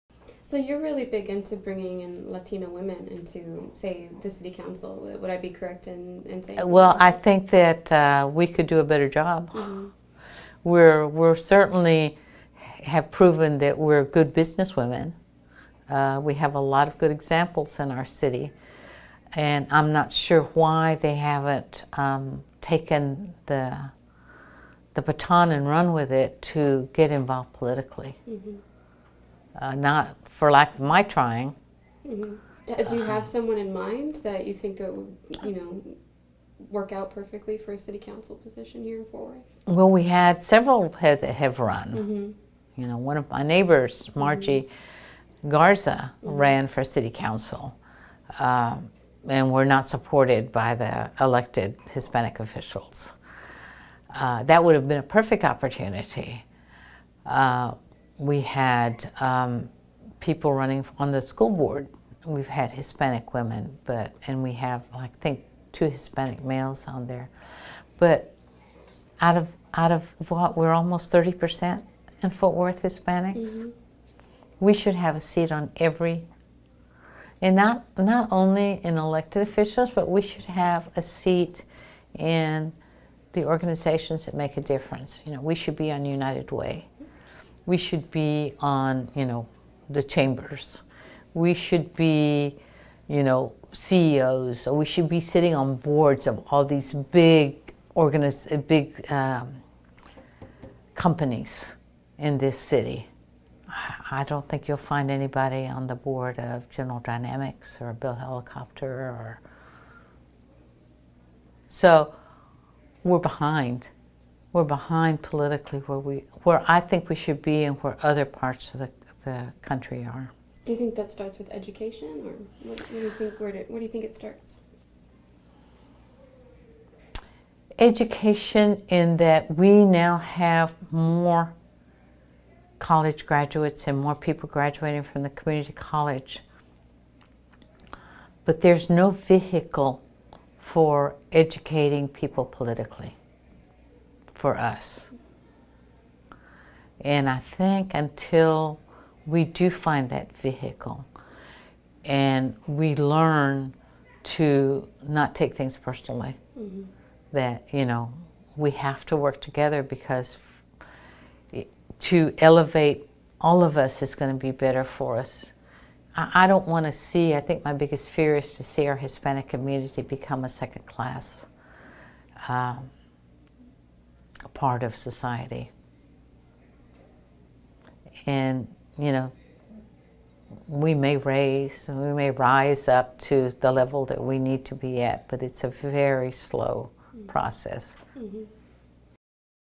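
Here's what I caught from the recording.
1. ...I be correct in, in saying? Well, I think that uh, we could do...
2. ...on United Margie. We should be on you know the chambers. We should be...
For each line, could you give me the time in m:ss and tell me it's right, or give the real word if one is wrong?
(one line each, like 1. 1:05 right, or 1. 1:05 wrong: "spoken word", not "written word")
1. 0:05 right
2. 1:25 wrong: "Way", not "Margie".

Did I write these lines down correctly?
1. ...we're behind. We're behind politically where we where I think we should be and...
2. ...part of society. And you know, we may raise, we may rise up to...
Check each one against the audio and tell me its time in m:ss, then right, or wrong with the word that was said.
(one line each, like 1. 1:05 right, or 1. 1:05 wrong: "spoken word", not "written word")
1. 1:53 right
2. 2:54 right.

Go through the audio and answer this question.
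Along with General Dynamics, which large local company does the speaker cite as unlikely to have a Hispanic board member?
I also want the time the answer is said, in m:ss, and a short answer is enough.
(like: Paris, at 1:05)
Bell Helicopter, at 1:47.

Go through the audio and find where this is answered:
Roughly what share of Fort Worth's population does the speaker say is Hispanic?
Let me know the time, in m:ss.
1:11.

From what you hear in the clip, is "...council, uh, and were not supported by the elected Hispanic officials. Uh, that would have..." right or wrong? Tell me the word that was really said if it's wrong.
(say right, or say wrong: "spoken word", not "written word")
right.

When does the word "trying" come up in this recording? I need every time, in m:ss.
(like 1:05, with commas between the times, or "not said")
0:31.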